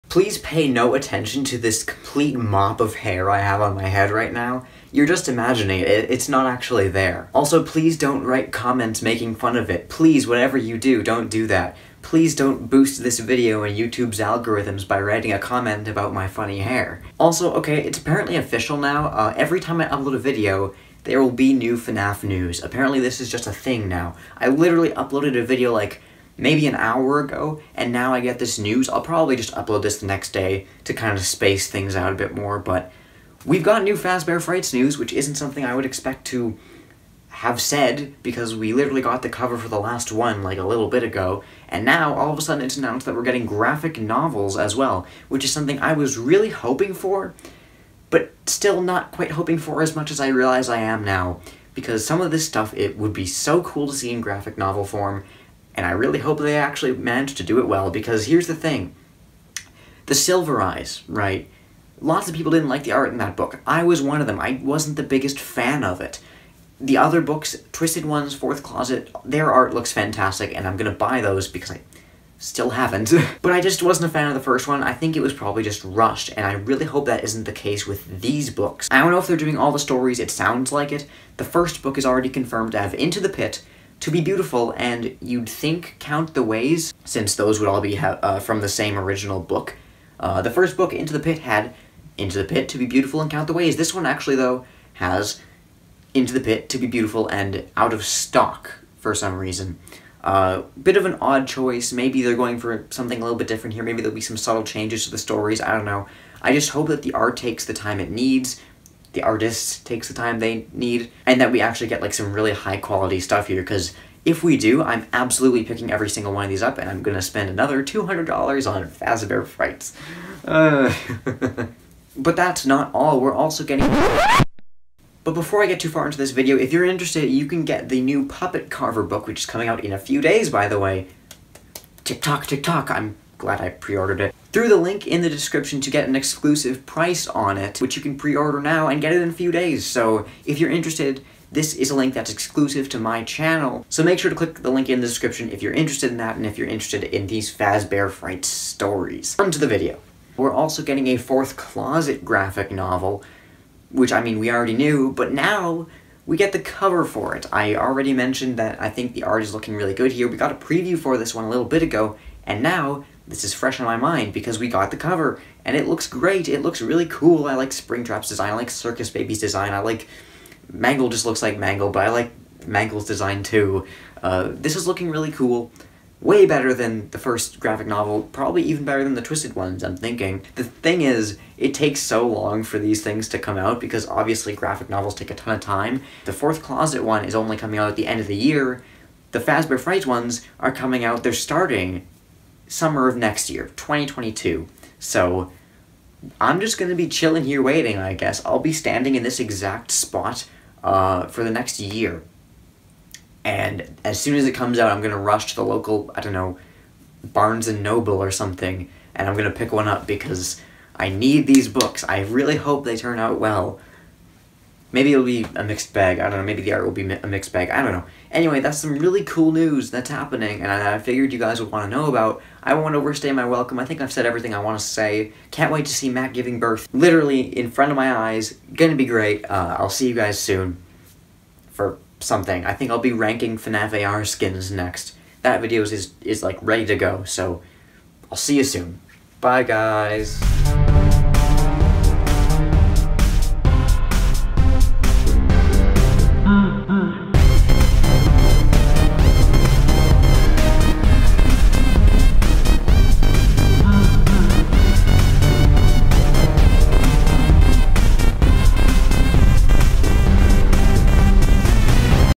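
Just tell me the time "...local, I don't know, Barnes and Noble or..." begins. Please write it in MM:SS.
03:25.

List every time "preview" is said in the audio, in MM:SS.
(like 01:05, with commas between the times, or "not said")
02:40.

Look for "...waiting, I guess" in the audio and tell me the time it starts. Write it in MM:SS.
03:17.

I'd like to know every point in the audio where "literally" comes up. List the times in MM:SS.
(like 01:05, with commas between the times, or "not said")
00:24, 00:38, 03:46.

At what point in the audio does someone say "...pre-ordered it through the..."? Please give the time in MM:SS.
02:13.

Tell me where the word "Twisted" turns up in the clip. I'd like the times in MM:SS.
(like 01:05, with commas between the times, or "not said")
01:07, 02:59.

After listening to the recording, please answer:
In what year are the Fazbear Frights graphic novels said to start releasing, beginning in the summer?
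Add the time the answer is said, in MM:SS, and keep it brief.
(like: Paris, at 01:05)
2022, at 03:13.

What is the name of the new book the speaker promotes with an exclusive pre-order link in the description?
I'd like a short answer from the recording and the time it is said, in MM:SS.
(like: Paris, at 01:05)
Puppet Carver, at 02:08.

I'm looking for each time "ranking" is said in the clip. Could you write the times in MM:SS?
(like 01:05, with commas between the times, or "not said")
03:53.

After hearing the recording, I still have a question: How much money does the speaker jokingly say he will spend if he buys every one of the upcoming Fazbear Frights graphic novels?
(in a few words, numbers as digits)
$200.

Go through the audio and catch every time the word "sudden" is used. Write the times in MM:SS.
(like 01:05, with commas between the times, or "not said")
00:42.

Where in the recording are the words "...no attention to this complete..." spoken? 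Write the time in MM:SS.
00:00.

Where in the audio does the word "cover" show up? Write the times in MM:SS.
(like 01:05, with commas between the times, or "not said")
00:39, 02:36, 02:44.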